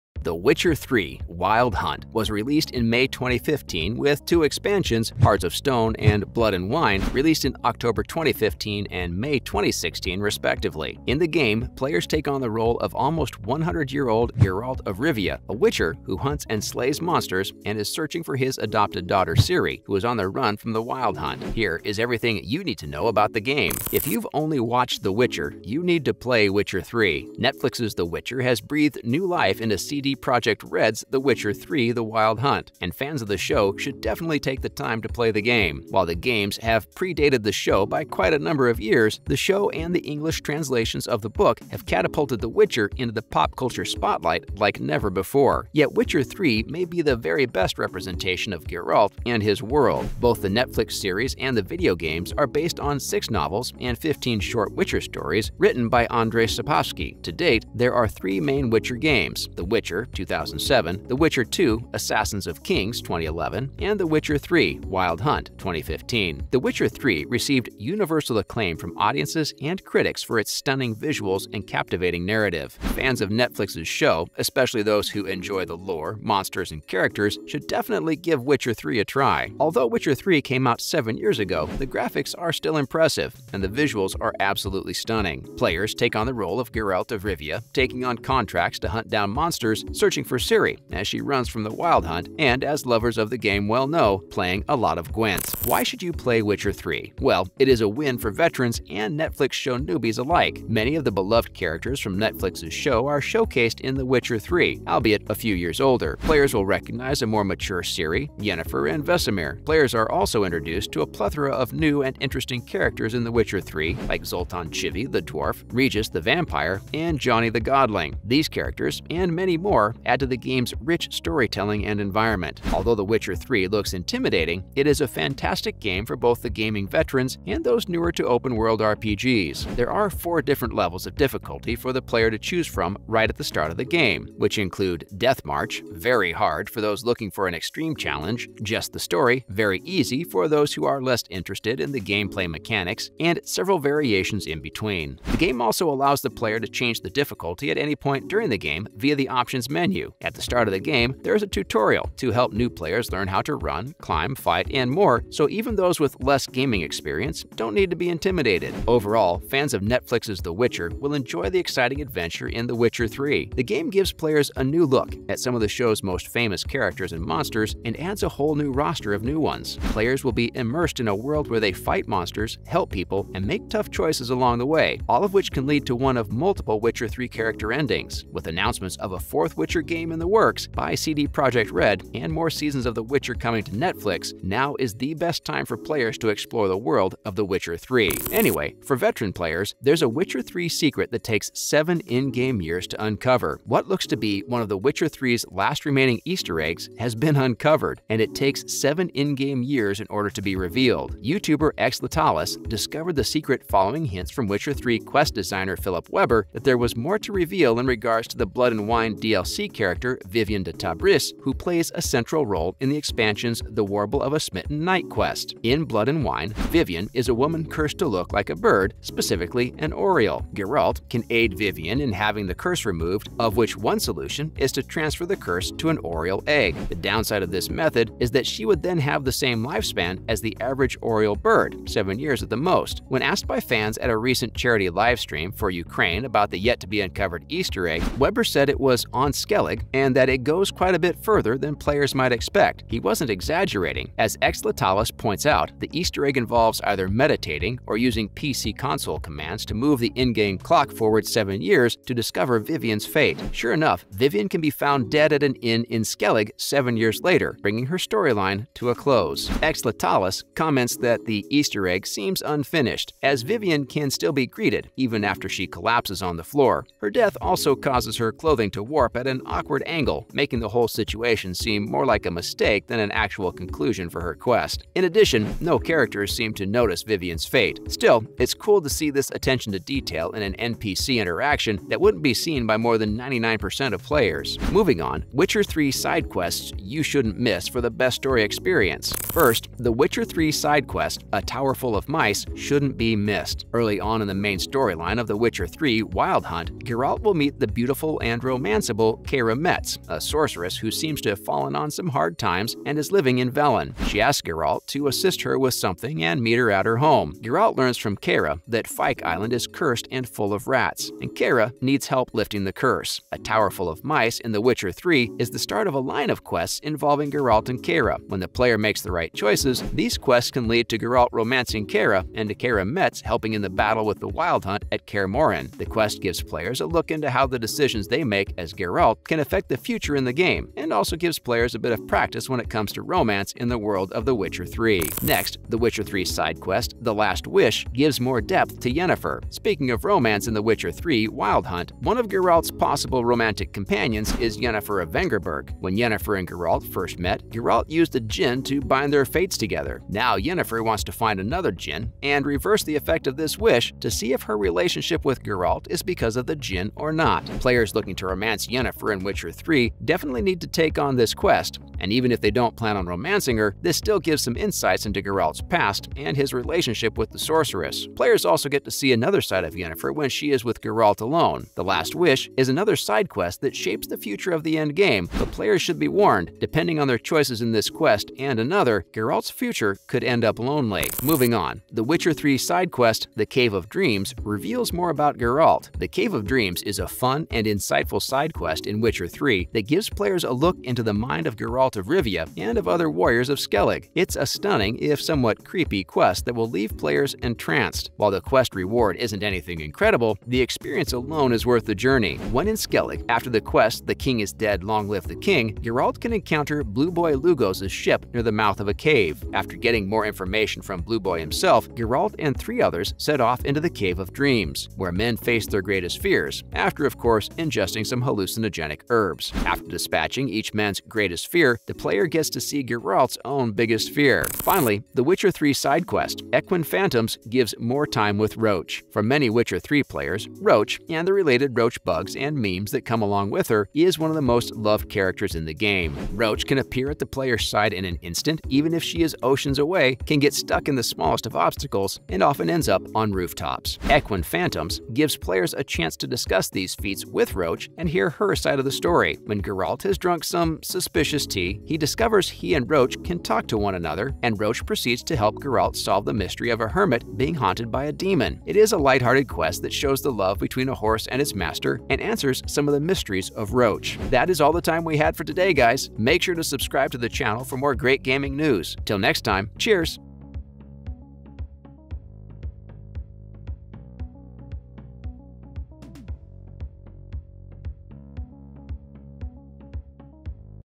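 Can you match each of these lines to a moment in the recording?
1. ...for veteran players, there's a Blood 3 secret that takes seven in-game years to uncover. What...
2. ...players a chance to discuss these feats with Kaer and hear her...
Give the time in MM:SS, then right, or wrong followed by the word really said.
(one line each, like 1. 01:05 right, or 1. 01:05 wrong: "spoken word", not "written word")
1. 03:08 wrong: "Witcher", not "Blood"
2. 07:25 wrong: "Roach", not "Kaer".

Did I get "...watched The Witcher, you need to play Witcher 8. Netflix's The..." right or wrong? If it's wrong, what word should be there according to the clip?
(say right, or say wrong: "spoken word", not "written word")
wrong: "3", not "8".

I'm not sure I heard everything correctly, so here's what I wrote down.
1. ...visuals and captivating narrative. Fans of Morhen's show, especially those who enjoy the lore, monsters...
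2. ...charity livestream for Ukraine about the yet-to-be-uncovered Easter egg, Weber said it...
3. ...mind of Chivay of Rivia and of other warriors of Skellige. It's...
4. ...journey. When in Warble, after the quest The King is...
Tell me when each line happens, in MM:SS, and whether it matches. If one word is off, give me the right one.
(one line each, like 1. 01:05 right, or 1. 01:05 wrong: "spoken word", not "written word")
1. 01:10 wrong: "Netflix", not "Morhen"
2. 03:54 right
3. 06:31 wrong: "Geralt", not "Chivay"
4. 06:41 wrong: "Skellige", not "Warble".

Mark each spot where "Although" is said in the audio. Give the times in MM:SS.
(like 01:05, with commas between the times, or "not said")
01:19, 02:02.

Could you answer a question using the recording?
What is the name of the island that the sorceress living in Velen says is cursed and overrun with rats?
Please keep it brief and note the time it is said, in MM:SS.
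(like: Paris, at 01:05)
Fyke Island, at 05:08.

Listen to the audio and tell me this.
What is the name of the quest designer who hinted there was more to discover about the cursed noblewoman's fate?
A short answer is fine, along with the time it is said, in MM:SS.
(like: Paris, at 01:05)
Philipp Weber, at 03:25.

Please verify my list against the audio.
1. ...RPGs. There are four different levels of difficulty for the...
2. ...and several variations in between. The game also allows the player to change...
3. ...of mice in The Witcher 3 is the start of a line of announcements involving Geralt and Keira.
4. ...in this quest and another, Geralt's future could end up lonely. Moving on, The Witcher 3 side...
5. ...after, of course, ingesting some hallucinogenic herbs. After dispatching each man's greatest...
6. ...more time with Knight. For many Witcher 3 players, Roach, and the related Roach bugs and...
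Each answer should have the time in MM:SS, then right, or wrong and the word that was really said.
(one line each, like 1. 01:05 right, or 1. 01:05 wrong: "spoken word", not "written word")
1. 02:08 right
2. 02:23 right
3. 05:13 wrong: "quests", not "announcements"
4. 06:17 right
5. 06:56 right
6. 07:07 wrong: "Roach", not "Knight".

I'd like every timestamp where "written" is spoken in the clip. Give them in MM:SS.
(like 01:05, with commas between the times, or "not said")
00:55.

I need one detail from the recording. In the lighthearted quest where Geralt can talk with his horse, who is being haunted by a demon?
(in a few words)
a hermit.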